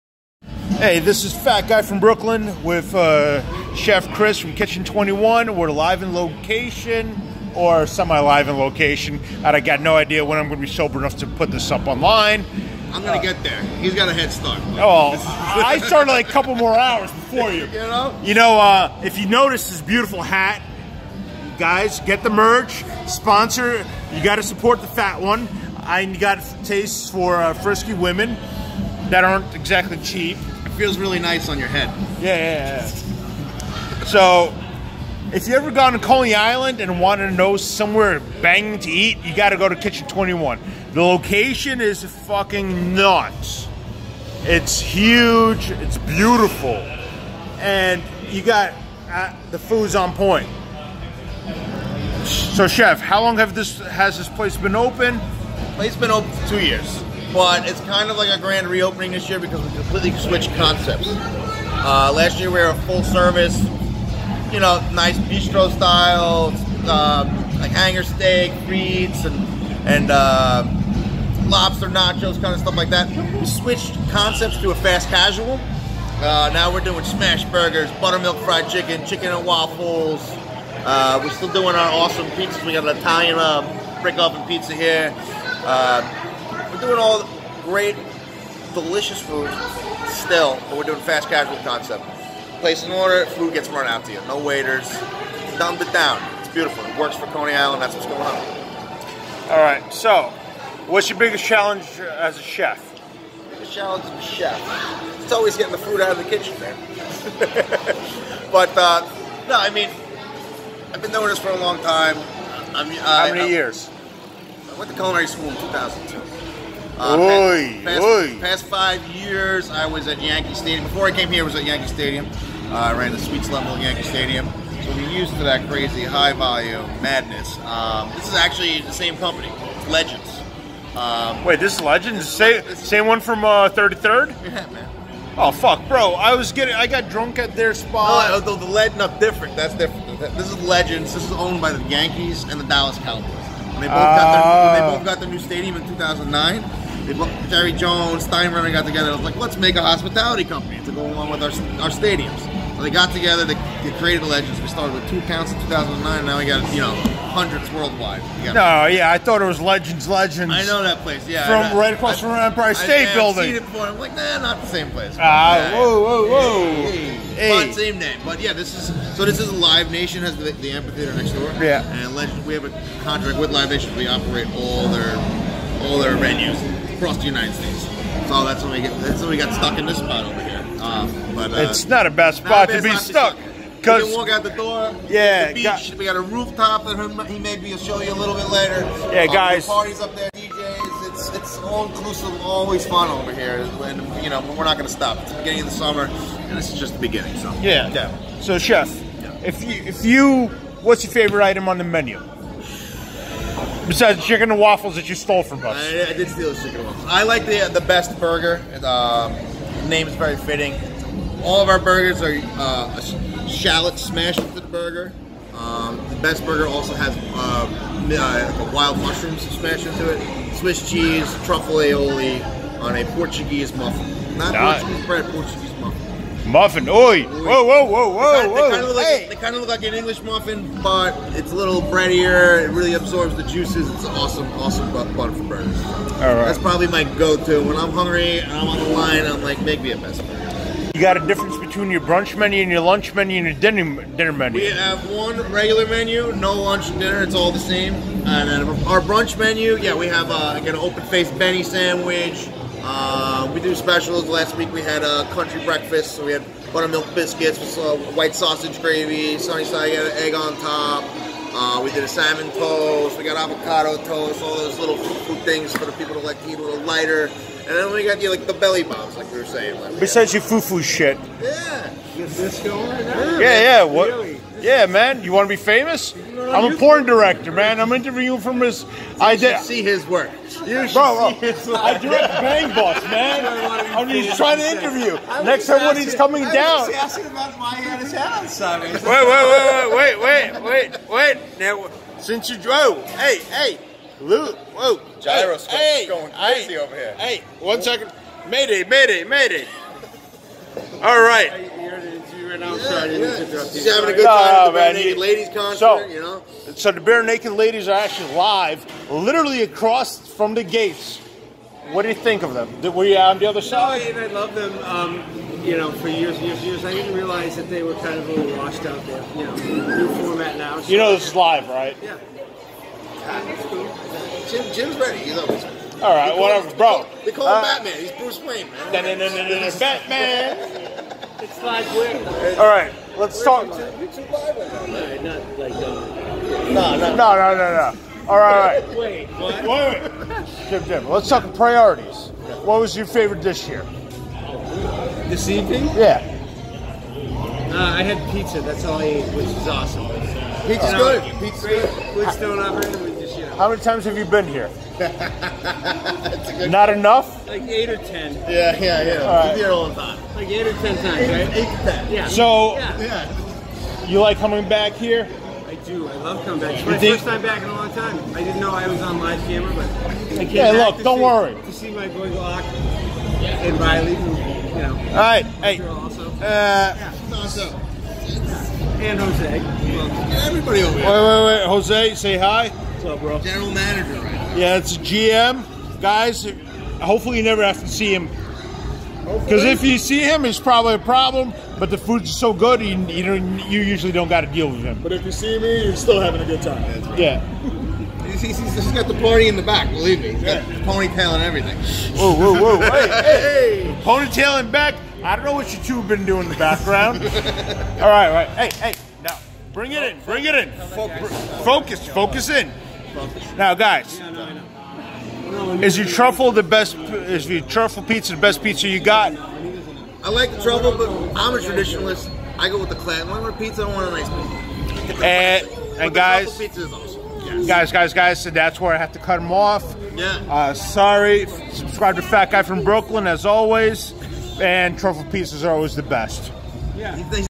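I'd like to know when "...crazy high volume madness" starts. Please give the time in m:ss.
2:05.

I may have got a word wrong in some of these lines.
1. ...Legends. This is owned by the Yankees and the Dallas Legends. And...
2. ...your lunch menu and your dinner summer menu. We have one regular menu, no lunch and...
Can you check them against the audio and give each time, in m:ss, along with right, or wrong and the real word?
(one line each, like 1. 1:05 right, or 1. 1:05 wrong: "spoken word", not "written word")
1. 2:20 wrong: "Cowboys", not "Legends"
2. 4:02 wrong: "dinner", not "summer".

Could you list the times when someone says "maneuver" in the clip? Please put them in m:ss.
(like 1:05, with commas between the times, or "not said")
not said.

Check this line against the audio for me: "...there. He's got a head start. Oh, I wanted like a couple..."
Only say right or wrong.
wrong.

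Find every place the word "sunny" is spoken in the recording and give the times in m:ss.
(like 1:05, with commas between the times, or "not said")
4:19.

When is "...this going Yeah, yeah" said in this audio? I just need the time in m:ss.
4:32.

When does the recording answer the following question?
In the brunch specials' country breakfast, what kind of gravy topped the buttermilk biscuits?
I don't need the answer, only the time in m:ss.
4:18.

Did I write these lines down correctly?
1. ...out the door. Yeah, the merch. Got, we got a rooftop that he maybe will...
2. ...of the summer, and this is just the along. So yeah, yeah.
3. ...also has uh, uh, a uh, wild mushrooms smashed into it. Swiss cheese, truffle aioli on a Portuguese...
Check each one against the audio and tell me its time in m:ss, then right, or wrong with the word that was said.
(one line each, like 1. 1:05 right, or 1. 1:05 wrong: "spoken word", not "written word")
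1. 3:04 wrong: "beach", not "merch"
2. 3:15 wrong: "beginning", not "along"
3. 3:36 right.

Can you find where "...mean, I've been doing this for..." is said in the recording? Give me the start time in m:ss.
1:49.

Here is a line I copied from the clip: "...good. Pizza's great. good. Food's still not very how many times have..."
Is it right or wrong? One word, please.
right.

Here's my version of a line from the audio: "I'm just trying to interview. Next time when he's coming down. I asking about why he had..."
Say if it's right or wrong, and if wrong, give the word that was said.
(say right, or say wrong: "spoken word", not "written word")
right.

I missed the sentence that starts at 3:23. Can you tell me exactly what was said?
Besides chicken and waffles that you stole from us.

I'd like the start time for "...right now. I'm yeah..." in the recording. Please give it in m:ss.
5:02.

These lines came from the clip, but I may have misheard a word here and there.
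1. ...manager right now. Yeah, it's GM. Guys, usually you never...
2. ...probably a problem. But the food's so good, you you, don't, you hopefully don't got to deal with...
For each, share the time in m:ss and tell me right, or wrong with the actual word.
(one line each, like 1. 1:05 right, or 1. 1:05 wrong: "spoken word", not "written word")
1. 6:23 wrong: "hopefully", not "usually"
2. 6:30 wrong: "usually", not "hopefully".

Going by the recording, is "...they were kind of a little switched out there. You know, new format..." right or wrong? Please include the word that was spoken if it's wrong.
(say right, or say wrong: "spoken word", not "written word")
wrong: "washed", not "switched".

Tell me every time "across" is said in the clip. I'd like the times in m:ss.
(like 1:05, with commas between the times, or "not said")
2:41, 2:57, 5:09.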